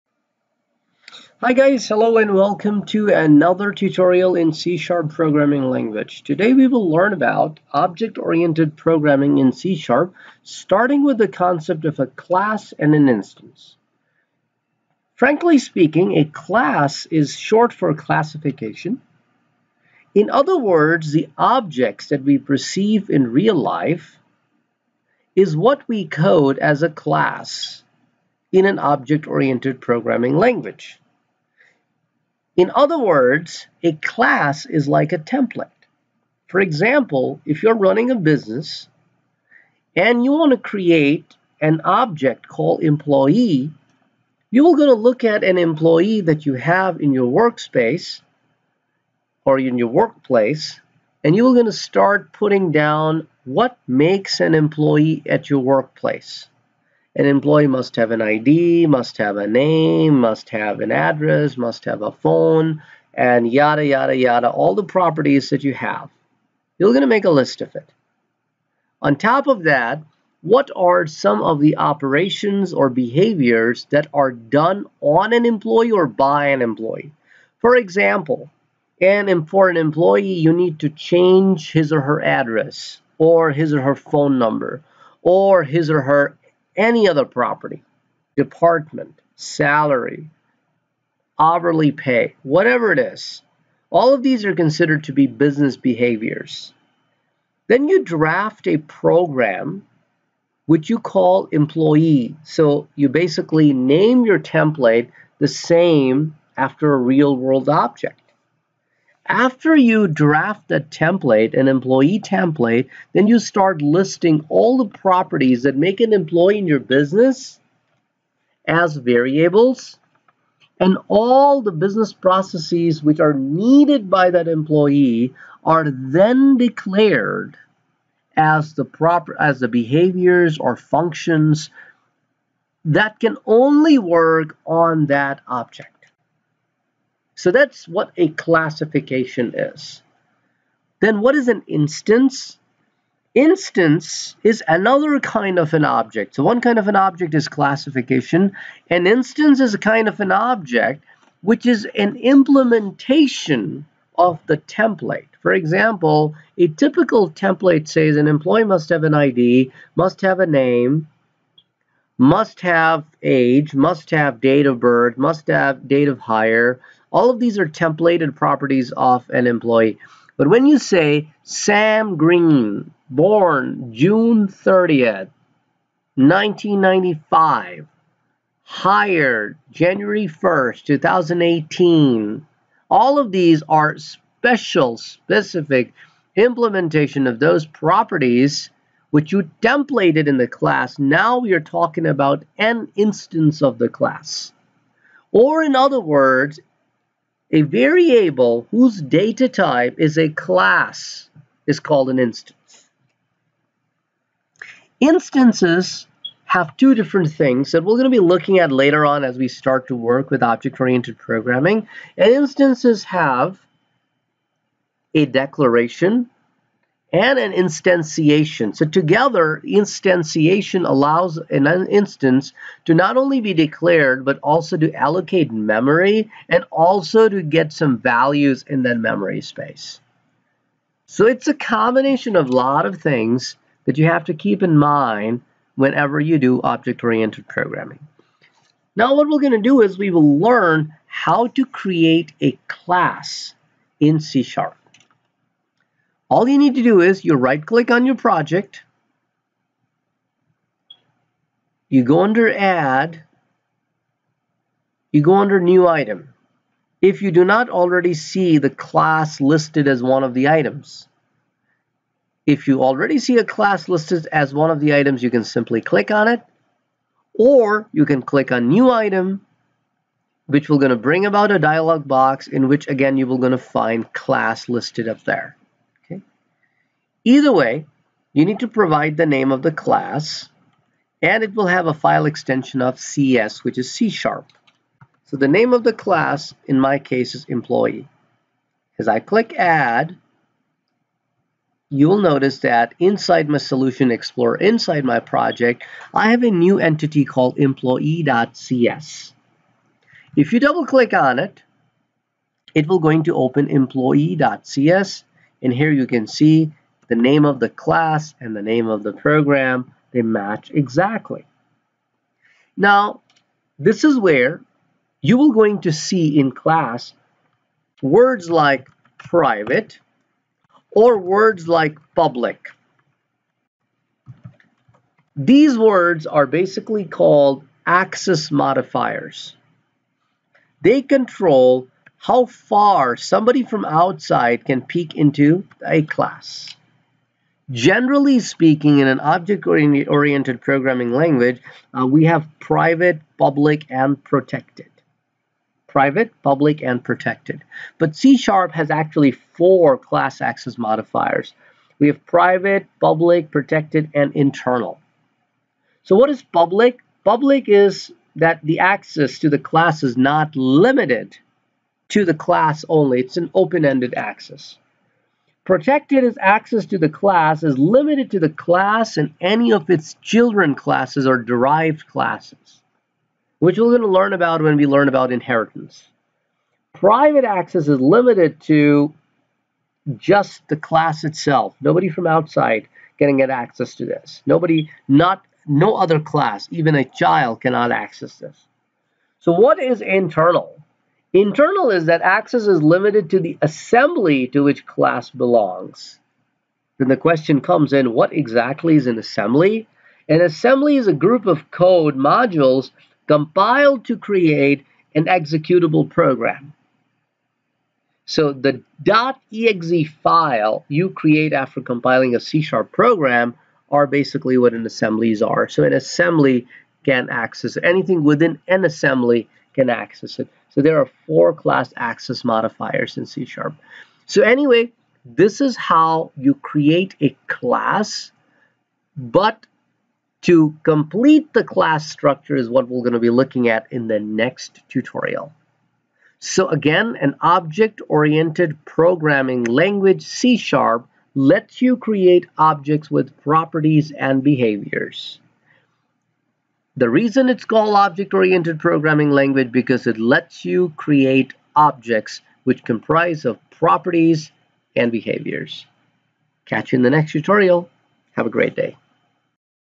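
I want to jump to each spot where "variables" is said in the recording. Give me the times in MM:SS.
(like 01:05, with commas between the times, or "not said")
01:58, 03:17.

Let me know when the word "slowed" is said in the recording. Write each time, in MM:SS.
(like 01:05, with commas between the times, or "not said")
not said.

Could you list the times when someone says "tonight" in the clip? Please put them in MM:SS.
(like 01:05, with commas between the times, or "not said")
not said.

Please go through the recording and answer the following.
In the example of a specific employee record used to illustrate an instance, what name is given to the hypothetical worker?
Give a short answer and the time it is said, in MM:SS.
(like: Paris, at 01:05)
Sam Green, at 02:51.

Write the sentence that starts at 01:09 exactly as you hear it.
On top of that, what are some of the operations or behaviors that are done on an employee or by an employee?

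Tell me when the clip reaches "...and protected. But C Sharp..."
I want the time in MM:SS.
05:46.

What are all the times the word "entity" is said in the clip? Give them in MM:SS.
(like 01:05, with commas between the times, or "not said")
04:56.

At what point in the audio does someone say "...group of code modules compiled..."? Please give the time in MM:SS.
06:41.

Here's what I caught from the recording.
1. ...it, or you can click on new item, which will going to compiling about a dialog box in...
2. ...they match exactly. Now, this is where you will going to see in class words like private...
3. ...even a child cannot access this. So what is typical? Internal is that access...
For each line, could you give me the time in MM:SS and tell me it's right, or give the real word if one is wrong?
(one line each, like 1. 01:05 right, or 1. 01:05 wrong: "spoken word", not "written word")
1. 04:26 wrong: "bring", not "compiling"
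2. 05:10 right
3. 06:26 wrong: "internal", not "typical".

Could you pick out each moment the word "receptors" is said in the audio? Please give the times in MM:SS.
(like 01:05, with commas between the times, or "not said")
not said.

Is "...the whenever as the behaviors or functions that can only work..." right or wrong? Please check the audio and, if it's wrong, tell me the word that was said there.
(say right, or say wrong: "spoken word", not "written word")
wrong: "proper", not "whenever".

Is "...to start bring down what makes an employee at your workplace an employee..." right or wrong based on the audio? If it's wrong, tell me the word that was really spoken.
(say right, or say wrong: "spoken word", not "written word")
wrong: "putting", not "bring".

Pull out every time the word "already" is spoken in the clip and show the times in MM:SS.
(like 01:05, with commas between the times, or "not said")
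04:17, 04:22.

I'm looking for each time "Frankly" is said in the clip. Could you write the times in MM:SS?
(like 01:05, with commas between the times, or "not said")
00:15.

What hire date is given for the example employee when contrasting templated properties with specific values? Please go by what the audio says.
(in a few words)
January 1st, 2018.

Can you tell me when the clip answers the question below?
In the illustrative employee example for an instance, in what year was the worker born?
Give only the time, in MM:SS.
02:56.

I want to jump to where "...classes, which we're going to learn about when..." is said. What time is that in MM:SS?
06:12.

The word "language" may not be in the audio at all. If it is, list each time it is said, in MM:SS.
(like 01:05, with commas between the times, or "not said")
00:05, 00:30, 05:41, 07:19, 07:29.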